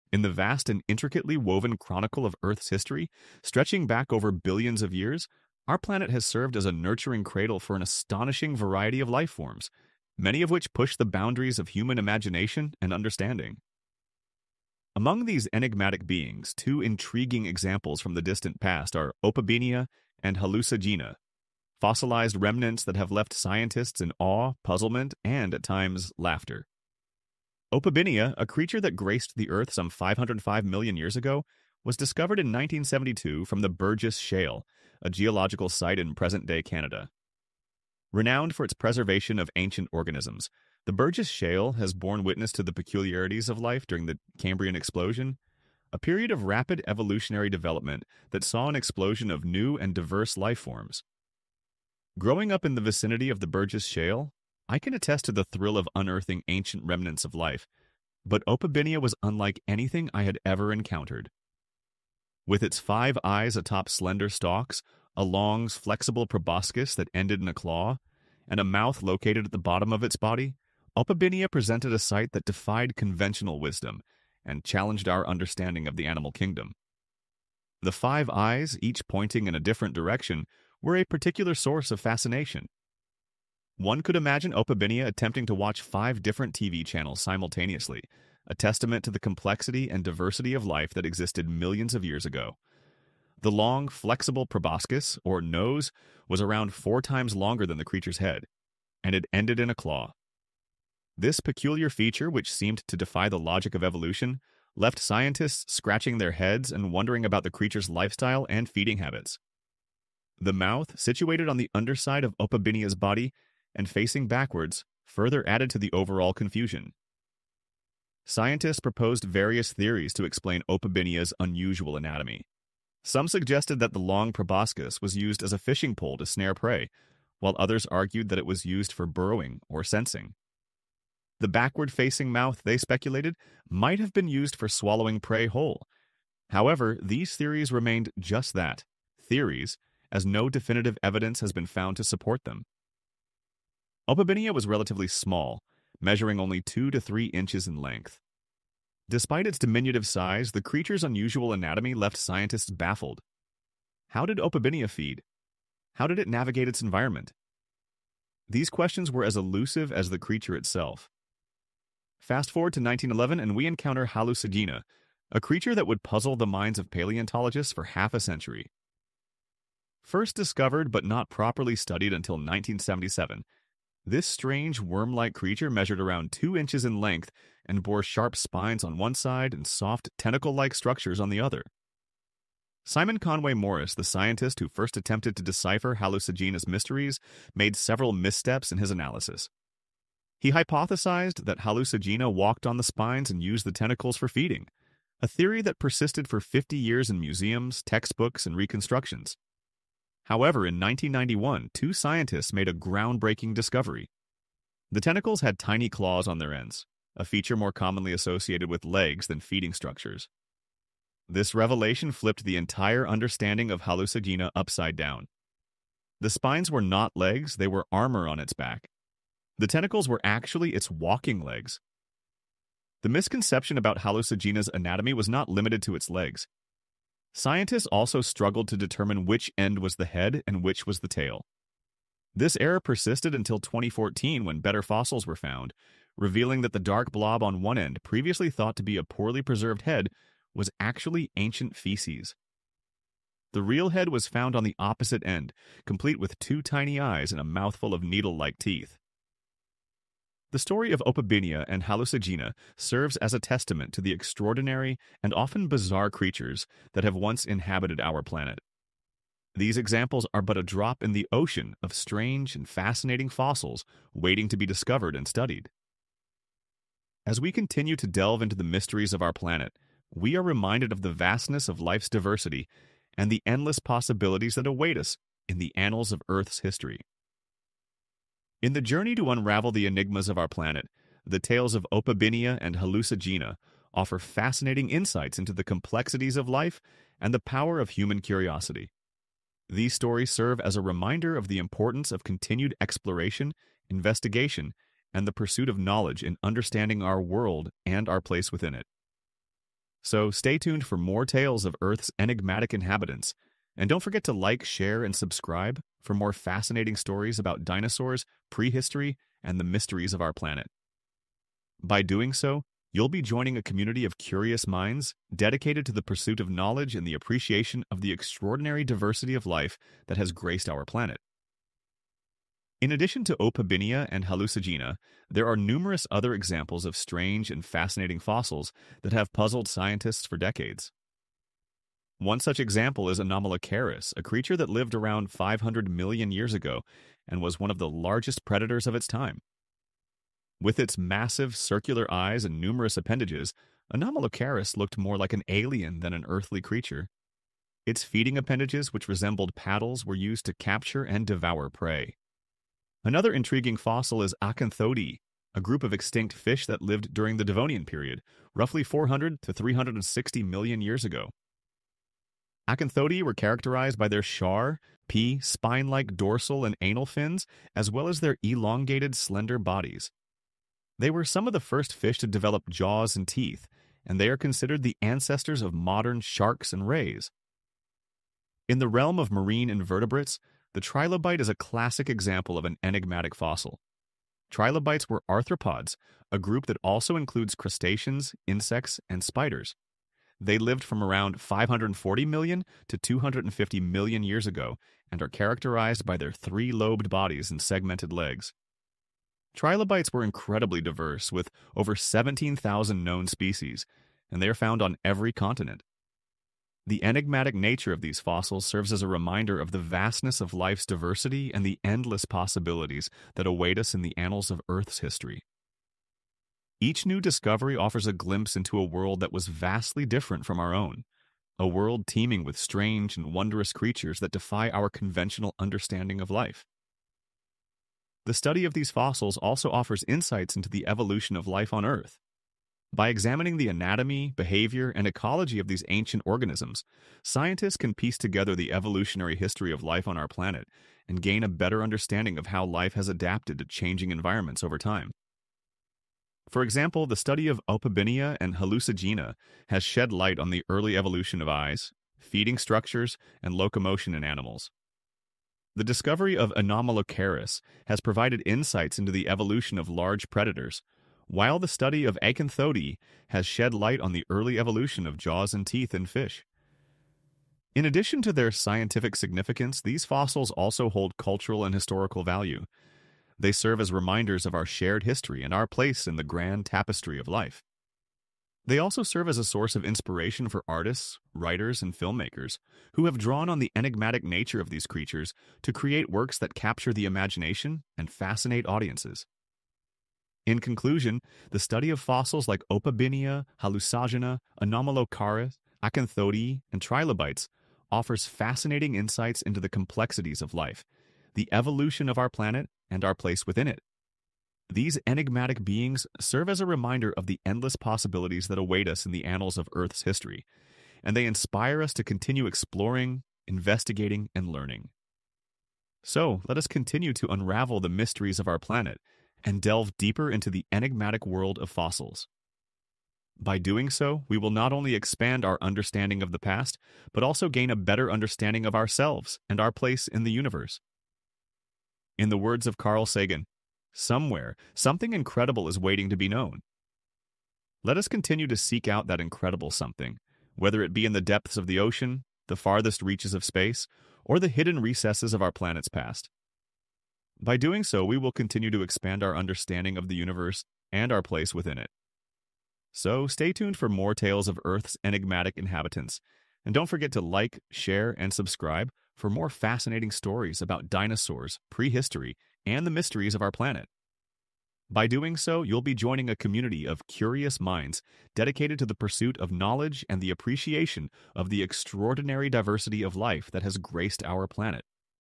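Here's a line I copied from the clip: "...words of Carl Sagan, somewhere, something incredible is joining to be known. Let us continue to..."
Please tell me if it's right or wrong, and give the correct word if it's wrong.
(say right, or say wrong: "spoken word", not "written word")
wrong: "waiting", not "joining".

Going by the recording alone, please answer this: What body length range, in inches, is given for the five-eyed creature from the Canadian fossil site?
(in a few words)
2 to 3 inches.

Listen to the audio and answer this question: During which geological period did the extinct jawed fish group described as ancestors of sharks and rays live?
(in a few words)
Devonian.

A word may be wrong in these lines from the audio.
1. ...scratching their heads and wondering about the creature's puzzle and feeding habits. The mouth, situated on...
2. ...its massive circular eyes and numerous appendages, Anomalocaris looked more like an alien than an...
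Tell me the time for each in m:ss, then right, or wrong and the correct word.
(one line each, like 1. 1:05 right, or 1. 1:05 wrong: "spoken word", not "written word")
1. 1:45 wrong: "lifestyle", not "puzzle"
2. 5:40 right.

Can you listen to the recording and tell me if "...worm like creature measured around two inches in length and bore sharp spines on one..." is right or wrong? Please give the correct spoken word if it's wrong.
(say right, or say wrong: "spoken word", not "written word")
right.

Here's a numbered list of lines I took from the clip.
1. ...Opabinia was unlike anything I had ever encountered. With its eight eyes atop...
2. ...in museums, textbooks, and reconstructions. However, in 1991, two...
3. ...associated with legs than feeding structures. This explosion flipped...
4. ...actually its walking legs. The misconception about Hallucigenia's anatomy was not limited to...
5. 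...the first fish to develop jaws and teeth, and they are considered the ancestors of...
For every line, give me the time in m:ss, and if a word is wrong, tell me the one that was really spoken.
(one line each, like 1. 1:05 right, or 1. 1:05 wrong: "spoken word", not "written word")
1. 0:58 wrong: "five", not "eight"
2. 3:17 right
3. 3:28 wrong: "revelation", not "explosion"
4. 3:40 right
5. 6:11 right.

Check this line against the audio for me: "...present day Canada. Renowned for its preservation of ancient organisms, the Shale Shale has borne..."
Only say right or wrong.
wrong.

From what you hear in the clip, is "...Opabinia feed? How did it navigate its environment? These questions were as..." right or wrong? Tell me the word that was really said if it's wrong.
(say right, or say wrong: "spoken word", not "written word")
right.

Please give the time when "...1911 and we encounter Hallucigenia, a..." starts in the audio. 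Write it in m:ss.
2:42.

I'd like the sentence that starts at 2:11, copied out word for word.
The backward facing mouth, they speculated, might have been used for swallowing prey whole.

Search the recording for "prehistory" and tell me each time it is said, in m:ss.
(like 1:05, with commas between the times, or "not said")
5:08, 9:21.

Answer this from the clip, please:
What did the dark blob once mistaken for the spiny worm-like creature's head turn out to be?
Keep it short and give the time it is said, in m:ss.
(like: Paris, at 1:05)
ancient feces, at 4:01.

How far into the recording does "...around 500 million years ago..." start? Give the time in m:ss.
5:34.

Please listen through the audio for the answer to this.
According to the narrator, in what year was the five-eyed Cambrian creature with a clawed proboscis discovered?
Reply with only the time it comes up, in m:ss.
0:32.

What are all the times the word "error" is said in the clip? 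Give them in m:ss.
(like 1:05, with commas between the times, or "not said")
3:52.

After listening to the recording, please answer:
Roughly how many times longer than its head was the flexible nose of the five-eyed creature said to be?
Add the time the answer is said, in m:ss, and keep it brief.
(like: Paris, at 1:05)
4, at 1:36.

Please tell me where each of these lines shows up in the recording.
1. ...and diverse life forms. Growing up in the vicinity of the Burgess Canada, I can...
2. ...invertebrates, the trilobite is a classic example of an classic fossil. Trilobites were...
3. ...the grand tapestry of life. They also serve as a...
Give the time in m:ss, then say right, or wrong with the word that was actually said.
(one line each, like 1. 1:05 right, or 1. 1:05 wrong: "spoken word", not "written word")
1. 0:49 wrong: "Shale", not "Canada"
2. 6:19 wrong: "enigmatic", not "classic"
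3. 7:56 right.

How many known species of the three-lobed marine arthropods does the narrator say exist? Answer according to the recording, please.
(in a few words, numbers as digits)
over 17,000.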